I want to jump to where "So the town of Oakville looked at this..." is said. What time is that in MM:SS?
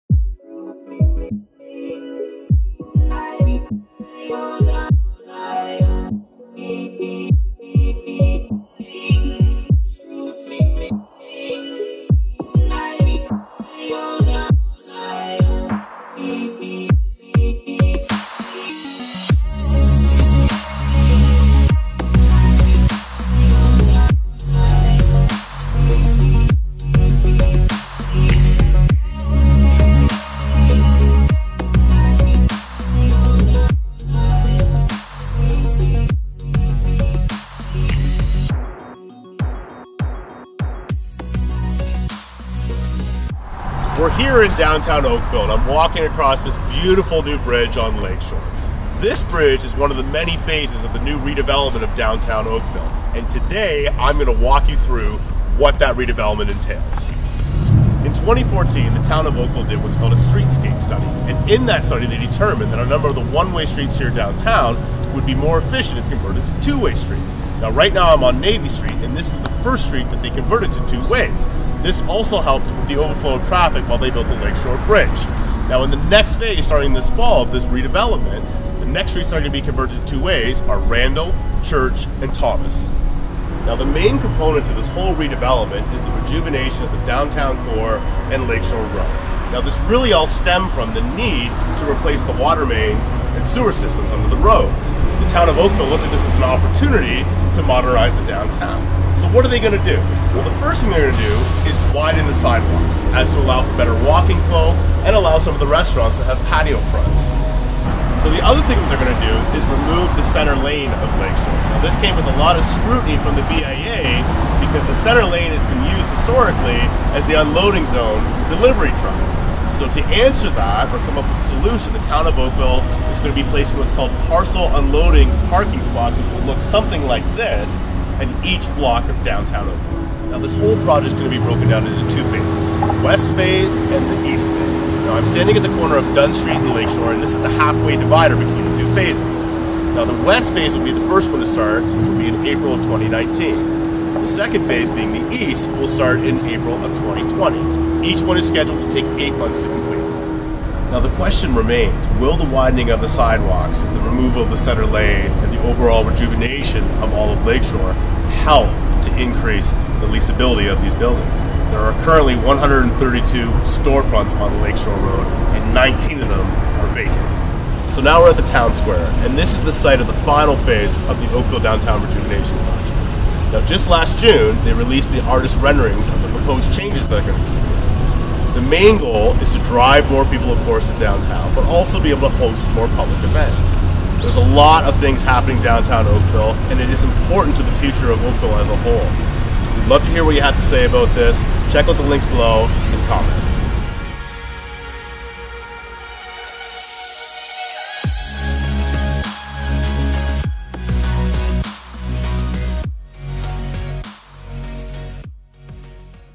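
01:34.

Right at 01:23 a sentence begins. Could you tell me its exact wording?
Now the main component to this whole redevelopment is the rejuvenation of the downtown core and Lakeshore Road.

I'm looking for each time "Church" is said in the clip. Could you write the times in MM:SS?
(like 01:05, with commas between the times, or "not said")
01:21.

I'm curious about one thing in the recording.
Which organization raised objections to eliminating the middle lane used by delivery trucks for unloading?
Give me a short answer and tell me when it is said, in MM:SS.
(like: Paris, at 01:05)
BIA, at 01:53.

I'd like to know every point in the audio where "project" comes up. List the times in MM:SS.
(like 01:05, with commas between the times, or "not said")
02:10, 02:52.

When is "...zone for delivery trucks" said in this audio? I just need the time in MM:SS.
01:57.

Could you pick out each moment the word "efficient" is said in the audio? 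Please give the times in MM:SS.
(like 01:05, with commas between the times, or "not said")
01:05.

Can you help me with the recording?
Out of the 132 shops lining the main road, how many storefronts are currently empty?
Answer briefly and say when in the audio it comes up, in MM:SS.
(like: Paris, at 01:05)
19, at 02:45.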